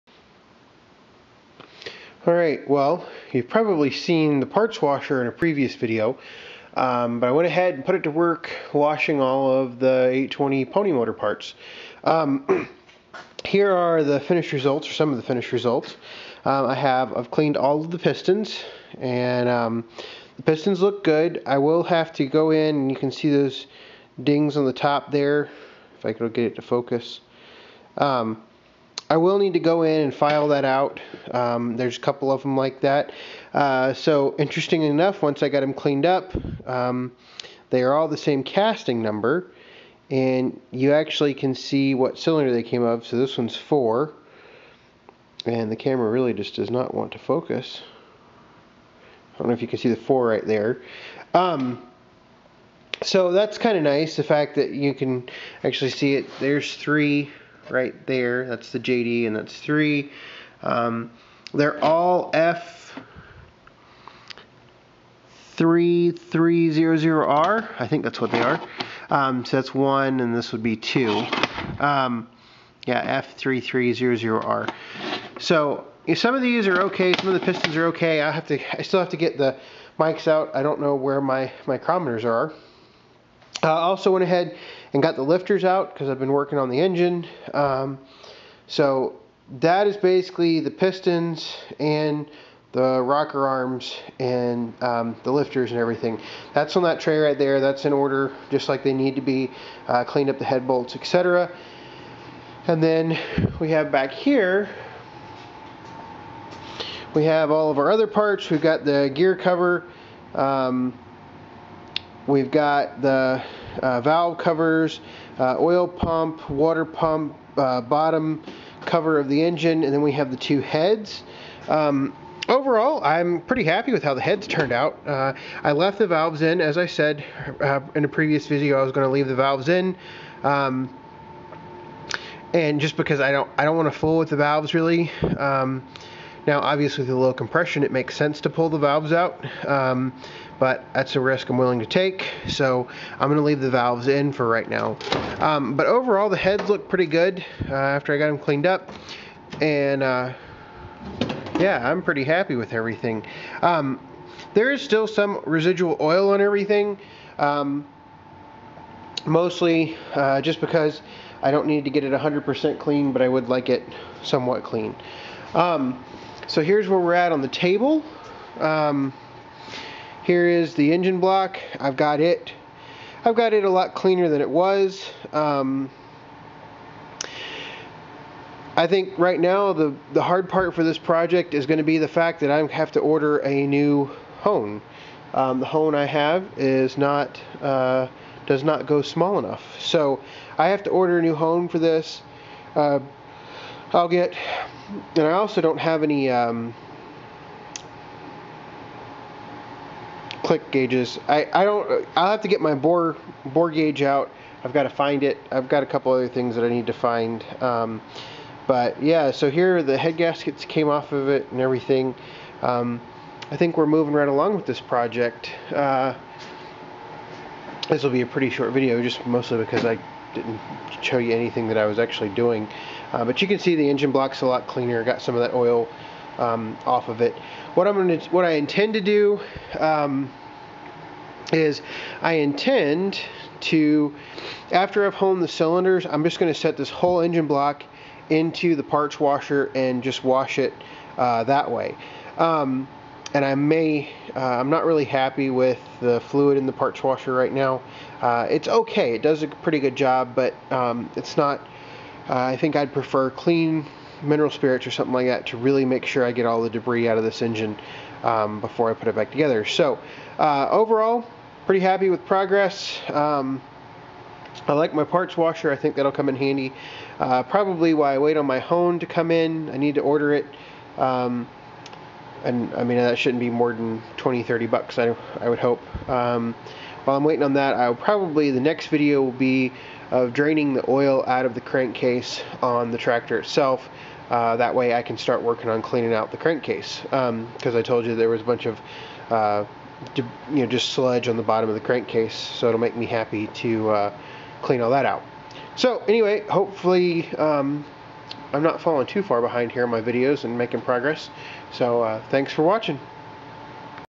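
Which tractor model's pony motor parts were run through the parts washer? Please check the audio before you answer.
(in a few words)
820.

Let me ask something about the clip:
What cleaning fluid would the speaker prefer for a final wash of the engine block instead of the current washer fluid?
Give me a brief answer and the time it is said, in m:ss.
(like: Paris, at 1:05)
mineral spirits, at 4:14.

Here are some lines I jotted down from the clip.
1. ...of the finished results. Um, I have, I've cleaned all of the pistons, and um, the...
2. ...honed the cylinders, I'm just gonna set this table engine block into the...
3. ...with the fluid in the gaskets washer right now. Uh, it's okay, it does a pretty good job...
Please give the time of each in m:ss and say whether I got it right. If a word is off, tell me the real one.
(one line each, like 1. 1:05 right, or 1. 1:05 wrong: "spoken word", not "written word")
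1. 0:15 right
2. 3:55 wrong: "whole", not "table"
3. 4:05 wrong: "parts", not "gaskets".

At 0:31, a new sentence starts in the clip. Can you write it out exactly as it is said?
Um, there's a couple of them like that.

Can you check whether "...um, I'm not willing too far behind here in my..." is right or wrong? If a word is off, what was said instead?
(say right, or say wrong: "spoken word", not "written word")
wrong: "falling", not "willing".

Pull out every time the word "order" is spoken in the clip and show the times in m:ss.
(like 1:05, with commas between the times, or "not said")
1:37, 3:02, 3:10, 4:30.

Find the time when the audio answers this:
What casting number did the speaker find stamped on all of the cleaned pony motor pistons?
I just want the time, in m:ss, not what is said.
1:13.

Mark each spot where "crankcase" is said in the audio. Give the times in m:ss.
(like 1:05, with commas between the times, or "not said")
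4:41, 4:46, 4:51.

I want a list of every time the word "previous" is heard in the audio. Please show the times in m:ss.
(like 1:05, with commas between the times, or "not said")
0:05, 2:08.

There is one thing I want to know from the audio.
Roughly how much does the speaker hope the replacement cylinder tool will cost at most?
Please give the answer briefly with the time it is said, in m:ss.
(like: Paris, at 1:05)
$30, at 4:34.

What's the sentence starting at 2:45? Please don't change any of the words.
Um, so here's where we're at on the table.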